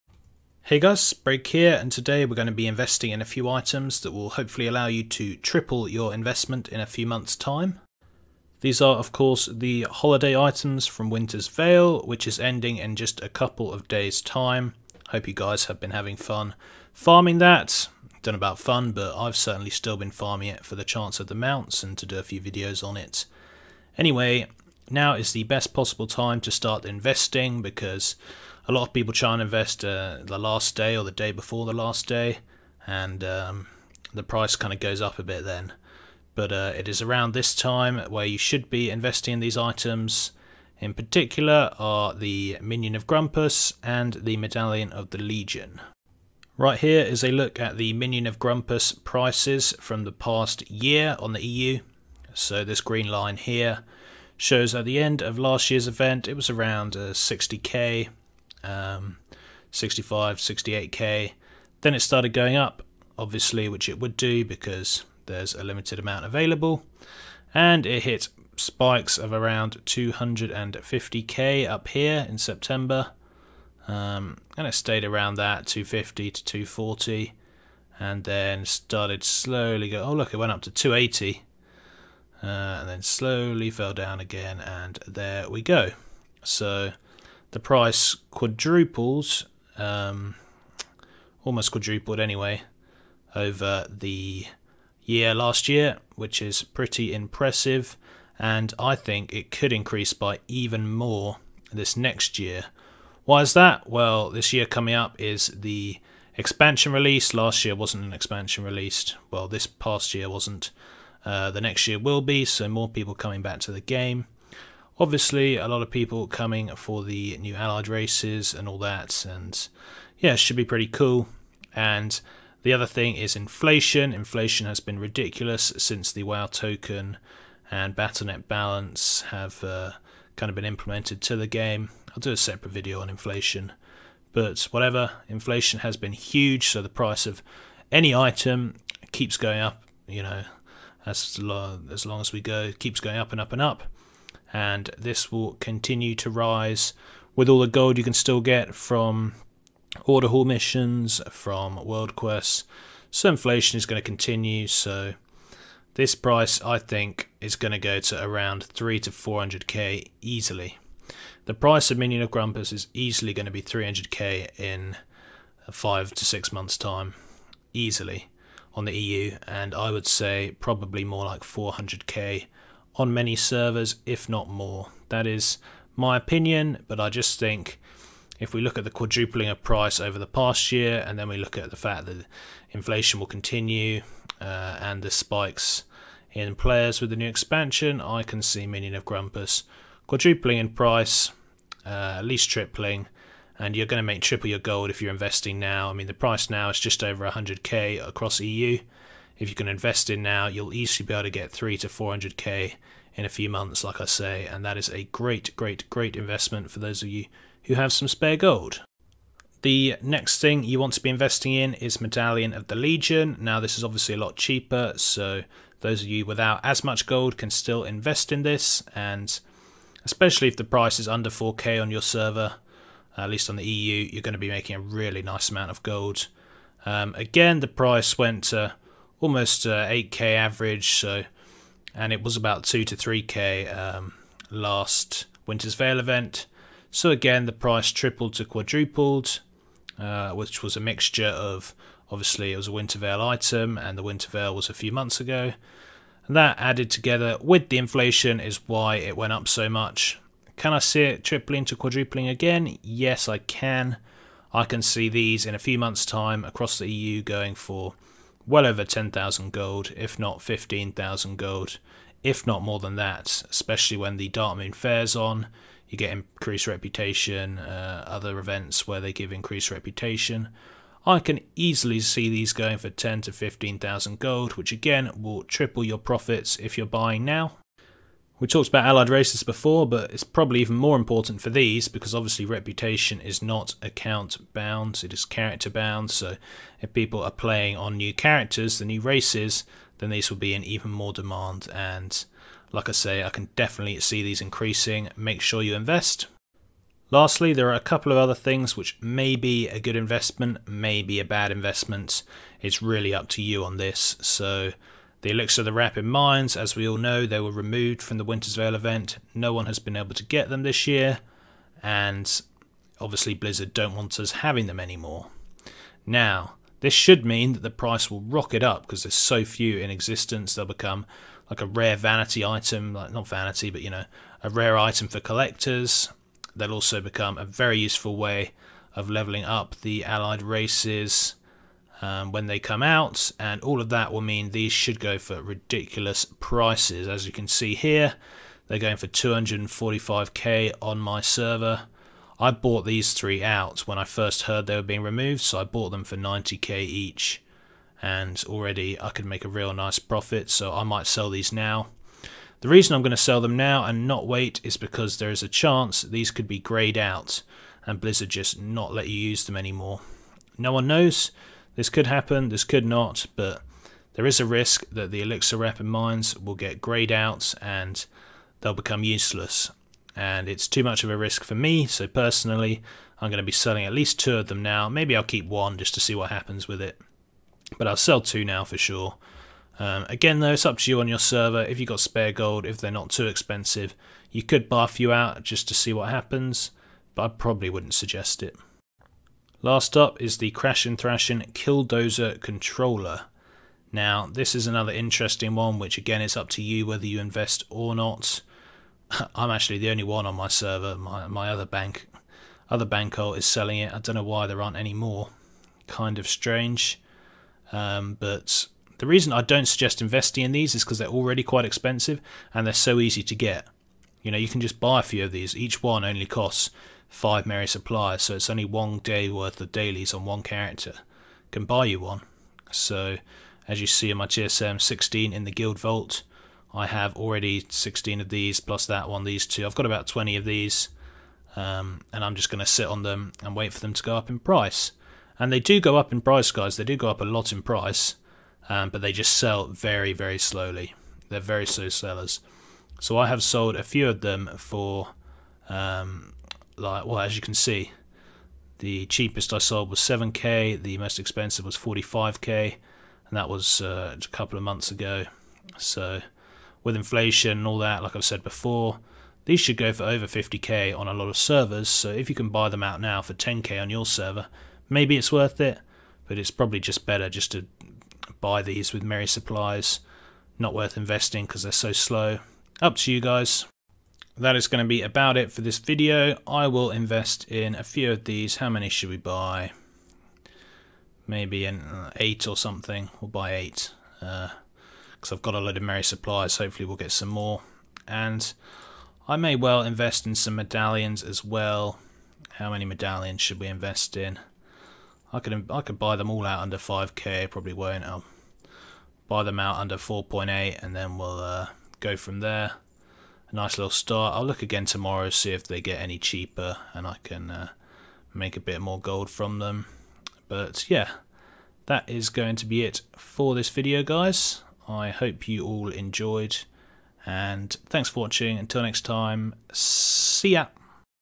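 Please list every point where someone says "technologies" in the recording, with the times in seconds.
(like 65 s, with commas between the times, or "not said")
not said.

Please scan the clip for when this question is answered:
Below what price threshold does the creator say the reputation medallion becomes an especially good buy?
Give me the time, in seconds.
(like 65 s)
221 s.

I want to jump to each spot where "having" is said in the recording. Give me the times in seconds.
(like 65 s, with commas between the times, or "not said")
15 s, 314 s.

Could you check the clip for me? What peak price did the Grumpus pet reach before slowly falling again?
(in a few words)
280.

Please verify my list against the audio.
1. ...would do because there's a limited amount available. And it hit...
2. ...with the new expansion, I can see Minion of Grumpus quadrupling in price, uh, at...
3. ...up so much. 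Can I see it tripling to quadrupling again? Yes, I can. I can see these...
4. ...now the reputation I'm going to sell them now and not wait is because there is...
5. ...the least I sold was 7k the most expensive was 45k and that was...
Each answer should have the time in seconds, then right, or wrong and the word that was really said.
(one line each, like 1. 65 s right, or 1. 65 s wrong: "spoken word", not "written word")
1. 63 s right
2. 187 s right
3. 249 s right
4. 351 s wrong: "reason", not "reputation"
5. 448 s wrong: "cheapest", not "least".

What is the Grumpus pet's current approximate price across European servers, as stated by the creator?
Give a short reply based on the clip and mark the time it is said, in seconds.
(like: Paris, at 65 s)
just over 100k, at 196 s.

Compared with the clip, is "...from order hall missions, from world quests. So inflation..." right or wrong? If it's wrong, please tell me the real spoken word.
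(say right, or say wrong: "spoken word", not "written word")
right.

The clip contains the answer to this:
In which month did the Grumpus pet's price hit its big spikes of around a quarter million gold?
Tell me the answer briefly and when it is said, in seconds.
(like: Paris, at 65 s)
September, at 72 s.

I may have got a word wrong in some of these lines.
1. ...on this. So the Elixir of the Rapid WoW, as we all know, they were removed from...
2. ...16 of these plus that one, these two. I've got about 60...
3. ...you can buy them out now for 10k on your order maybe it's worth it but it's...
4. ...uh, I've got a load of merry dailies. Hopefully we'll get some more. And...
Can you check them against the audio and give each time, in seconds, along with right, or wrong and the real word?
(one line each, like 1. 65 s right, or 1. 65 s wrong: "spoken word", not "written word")
1. 303 s wrong: "Minds", not "WoW"
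2. 427 s wrong: "20", not "60"
3. 462 s wrong: "server", not "order"
4. 485 s wrong: "supplies", not "dailies".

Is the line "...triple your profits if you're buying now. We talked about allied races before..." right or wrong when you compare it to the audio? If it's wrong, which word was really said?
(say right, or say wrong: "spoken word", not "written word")
right.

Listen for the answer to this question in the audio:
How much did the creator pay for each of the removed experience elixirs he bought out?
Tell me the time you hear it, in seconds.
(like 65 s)
346 s.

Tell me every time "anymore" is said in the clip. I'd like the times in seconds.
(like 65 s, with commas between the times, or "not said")
314 s, 359 s.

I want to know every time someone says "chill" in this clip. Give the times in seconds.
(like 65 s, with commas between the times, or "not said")
not said.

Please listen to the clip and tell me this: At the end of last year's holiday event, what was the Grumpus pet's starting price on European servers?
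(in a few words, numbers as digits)
60k.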